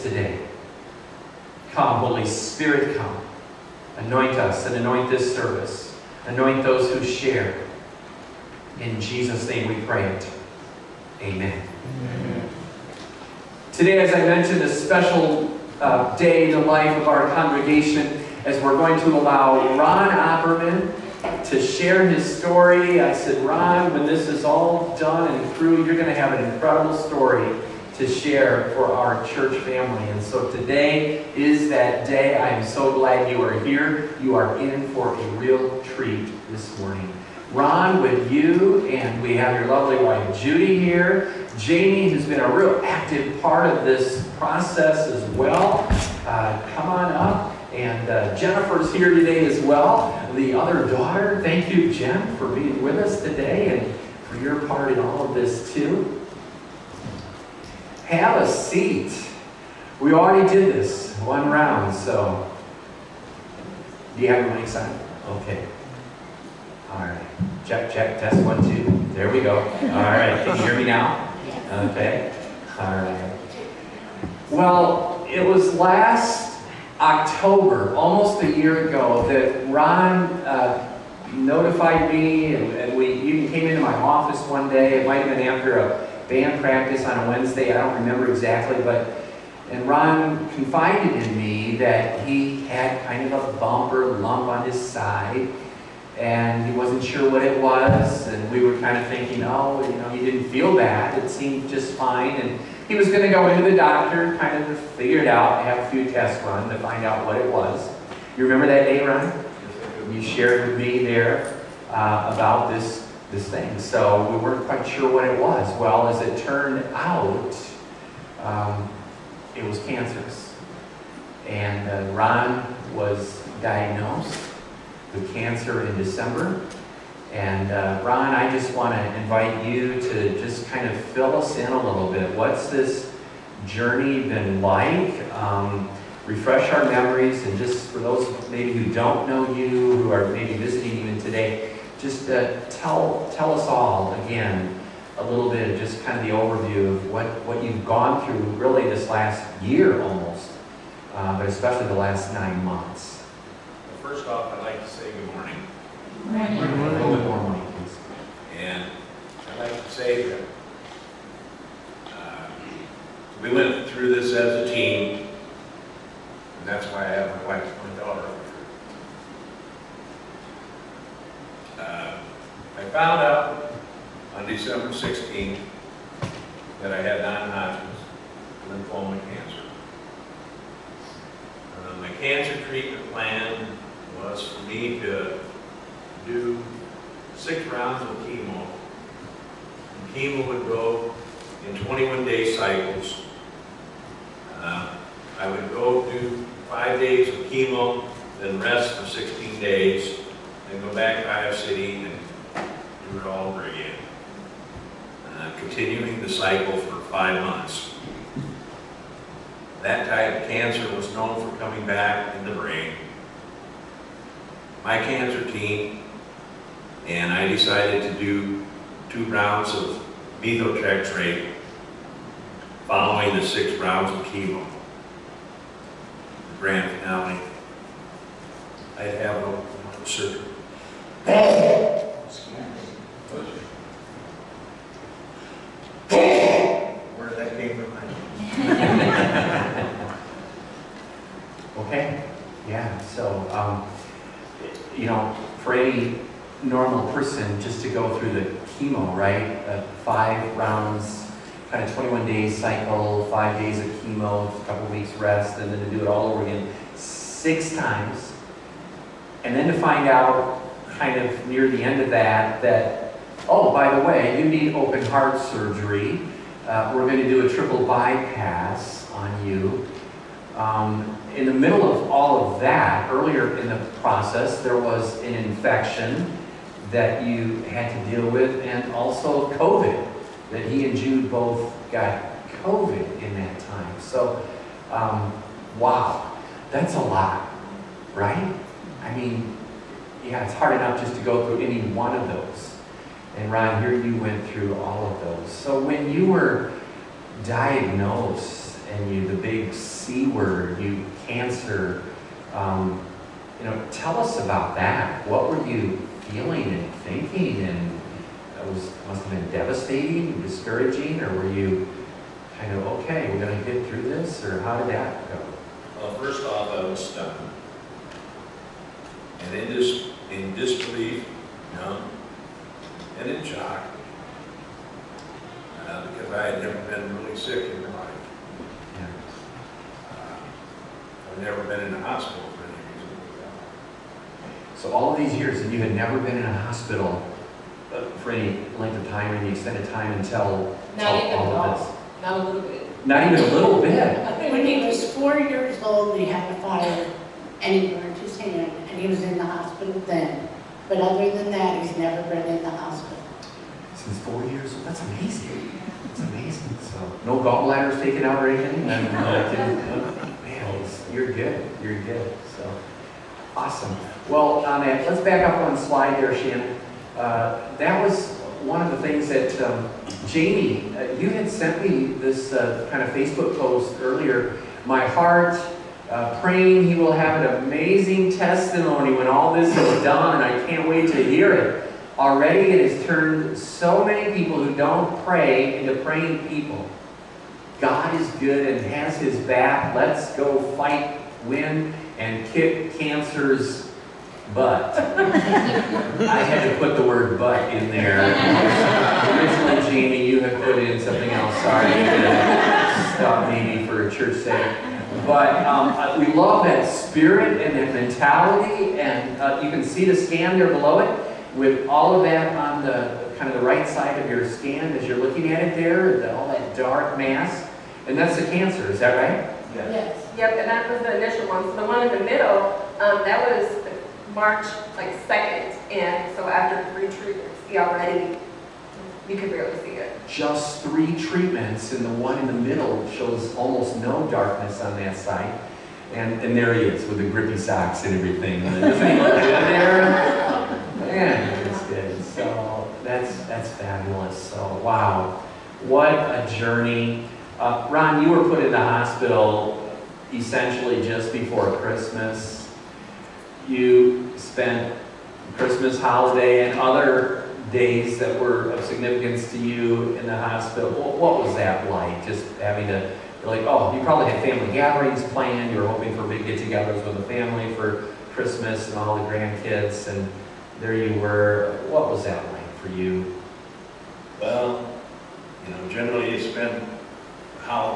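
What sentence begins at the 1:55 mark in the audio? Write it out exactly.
Well, as it turned out, um, it was cancerous.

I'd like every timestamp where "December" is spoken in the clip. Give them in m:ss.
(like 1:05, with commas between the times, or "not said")
2:05, 2:54.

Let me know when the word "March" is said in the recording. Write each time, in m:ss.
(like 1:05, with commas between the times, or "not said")
7:04.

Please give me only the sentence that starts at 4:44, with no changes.
So, um, wow, that's a lot, right?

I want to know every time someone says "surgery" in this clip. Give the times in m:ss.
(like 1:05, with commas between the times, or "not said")
3:50, 4:25.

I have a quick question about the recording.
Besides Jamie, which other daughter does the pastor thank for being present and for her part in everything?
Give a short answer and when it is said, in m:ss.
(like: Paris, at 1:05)
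Jennifer, at 0:48.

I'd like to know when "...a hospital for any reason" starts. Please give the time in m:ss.
5:31.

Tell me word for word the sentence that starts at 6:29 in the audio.
Let's go fight, win, and kick cancer's butt.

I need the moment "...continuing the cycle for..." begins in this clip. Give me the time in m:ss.
3:25.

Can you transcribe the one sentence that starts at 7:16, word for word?
And, and there he is with the grippy socks and everything.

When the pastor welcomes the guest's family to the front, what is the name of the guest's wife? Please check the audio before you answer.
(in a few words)
Judy.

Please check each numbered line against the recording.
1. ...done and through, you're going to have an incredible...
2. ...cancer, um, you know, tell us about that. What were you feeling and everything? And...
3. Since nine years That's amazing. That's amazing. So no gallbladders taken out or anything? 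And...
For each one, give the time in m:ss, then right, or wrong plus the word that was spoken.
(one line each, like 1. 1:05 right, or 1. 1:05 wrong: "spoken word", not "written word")
1. 0:24 right
2. 5:01 wrong: "thinking", not "everything"
3. 5:53 wrong: "four", not "nine".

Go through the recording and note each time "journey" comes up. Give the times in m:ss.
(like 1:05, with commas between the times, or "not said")
2:13, 7:26.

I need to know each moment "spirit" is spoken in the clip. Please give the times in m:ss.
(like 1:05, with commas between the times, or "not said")
0:02, 6:46.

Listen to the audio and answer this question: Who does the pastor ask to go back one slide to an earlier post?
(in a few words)
Shannon.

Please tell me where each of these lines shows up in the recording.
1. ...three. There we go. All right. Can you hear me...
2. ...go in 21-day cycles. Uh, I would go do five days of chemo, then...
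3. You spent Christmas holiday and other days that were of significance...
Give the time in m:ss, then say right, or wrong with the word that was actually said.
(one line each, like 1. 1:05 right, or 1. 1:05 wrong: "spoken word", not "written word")
1. 1:08 wrong: "two", not "three"
2. 3:10 right
3. 7:33 right.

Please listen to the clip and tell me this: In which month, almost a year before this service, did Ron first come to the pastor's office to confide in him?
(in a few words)
October.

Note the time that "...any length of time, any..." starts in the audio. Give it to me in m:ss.
5:38.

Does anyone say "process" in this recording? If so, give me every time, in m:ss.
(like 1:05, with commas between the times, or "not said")
0:44, 4:34.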